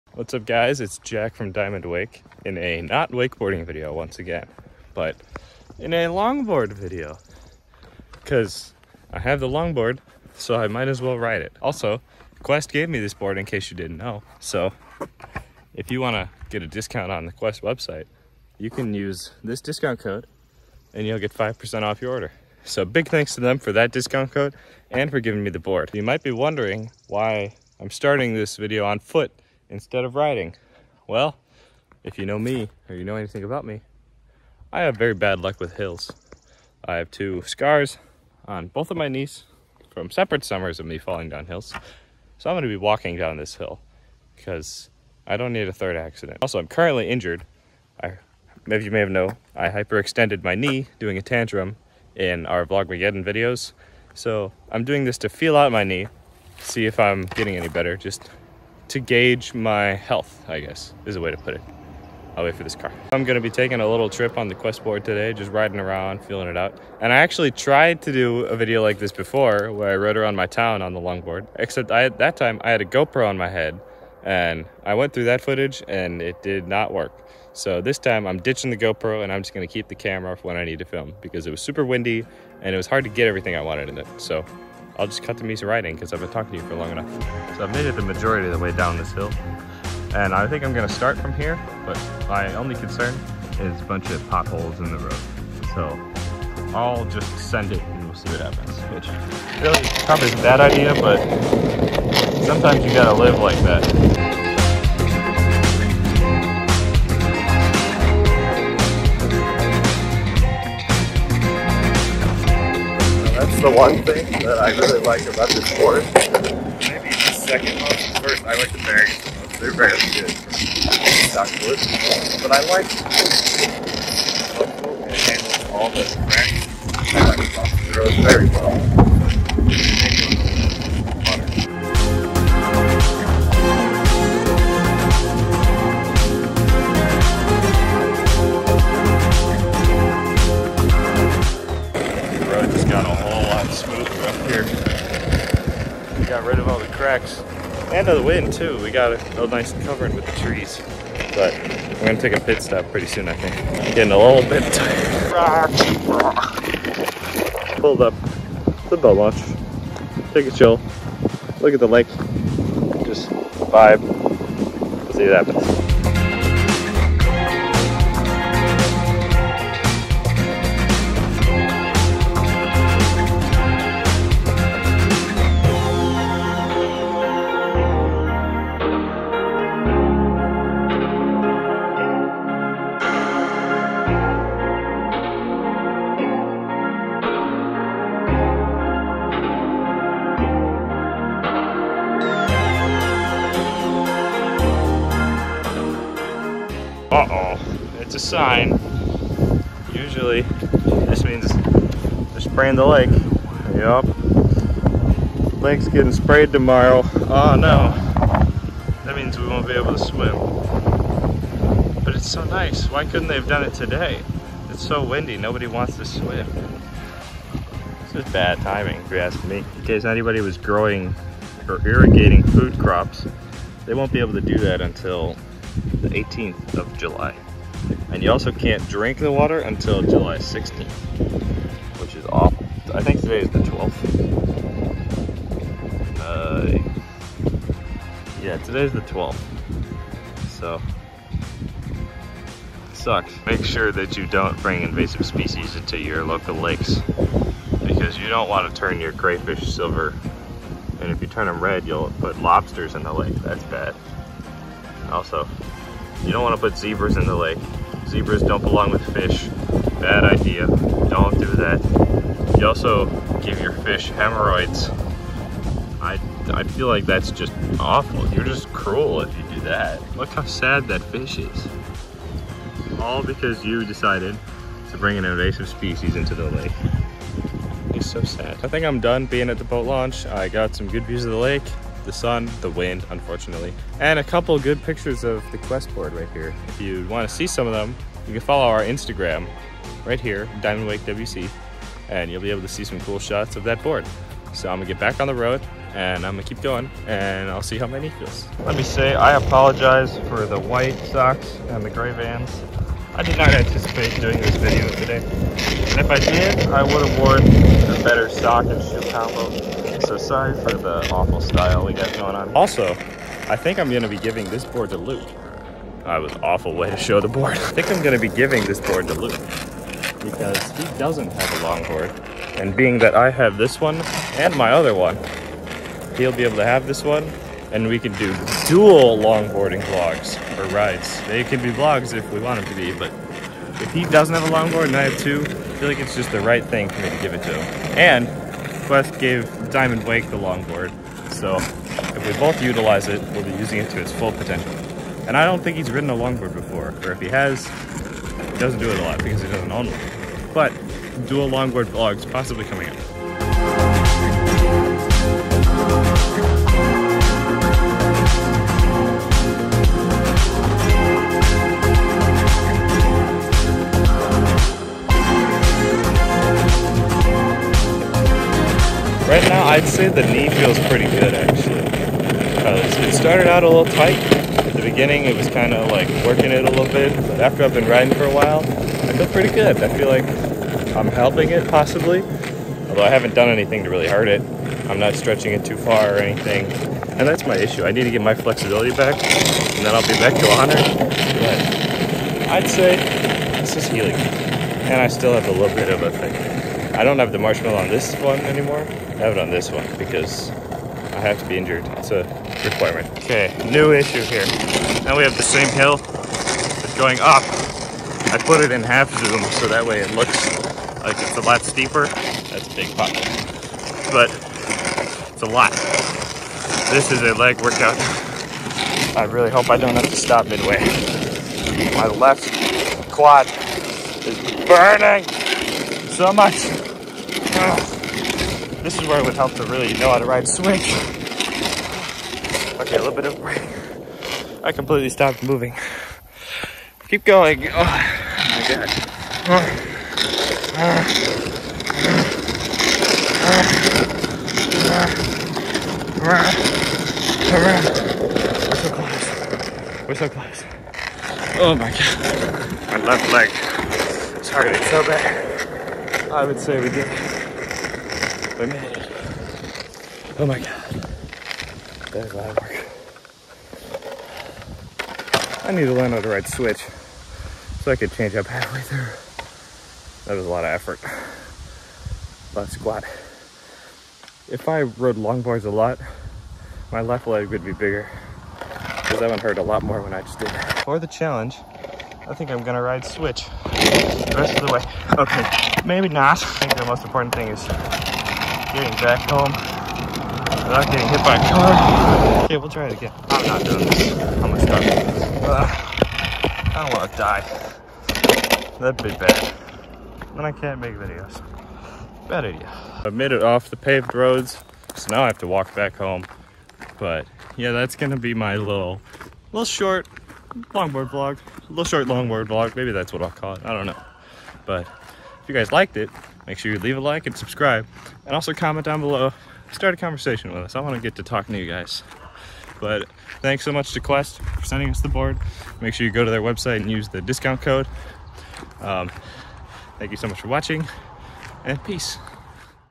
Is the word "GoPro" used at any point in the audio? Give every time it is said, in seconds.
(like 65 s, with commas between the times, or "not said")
72 s, 78 s.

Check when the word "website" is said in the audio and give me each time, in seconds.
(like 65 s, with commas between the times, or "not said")
17 s, 526 s.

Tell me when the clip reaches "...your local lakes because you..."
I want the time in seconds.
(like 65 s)
245 s.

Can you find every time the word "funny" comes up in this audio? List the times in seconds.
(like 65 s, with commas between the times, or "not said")
not said.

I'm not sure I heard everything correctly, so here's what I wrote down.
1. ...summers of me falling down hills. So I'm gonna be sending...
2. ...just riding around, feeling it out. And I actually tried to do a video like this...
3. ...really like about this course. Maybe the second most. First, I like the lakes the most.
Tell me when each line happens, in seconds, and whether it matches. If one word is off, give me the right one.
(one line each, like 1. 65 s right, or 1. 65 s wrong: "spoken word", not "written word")
1. 40 s wrong: "walking", not "sending"
2. 65 s right
3. 114 s wrong: "berries", not "lakes".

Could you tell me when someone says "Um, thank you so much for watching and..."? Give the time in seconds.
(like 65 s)
528 s.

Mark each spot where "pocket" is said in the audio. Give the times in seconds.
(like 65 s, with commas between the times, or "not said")
412 s.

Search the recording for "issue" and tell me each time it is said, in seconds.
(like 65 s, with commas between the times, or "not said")
387 s, 403 s.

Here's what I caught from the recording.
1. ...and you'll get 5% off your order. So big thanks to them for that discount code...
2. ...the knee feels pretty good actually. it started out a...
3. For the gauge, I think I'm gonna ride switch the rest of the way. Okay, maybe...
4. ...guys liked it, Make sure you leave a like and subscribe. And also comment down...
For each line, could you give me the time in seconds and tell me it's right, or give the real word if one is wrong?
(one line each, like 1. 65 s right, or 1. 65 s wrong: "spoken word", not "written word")
1. 20 s right
2. 370 s right
3. 480 s wrong: "challenge", not "gauge"
4. 515 s right.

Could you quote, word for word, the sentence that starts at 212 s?
Why couldn't they have done it today?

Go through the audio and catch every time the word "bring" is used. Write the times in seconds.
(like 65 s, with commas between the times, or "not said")
244 s, 274 s.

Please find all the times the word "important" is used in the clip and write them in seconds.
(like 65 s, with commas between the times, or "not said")
487 s.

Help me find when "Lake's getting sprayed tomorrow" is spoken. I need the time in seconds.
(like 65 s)
205 s.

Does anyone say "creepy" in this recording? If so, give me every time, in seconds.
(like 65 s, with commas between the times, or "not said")
not said.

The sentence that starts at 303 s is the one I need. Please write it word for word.
I did not anticipate doing this video today.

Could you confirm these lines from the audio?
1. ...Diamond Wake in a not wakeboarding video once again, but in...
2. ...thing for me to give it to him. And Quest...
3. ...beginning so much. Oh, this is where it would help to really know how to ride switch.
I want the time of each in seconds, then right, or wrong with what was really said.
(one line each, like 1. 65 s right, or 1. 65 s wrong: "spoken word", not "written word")
1. 1 s right
2. 336 s right
3. 424 s wrong: "burning", not "beginning".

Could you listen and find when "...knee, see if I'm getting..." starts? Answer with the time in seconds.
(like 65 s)
55 s.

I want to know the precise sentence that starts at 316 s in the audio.
I was awful way to show the board.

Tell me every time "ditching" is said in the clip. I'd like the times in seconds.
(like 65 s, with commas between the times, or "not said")
78 s.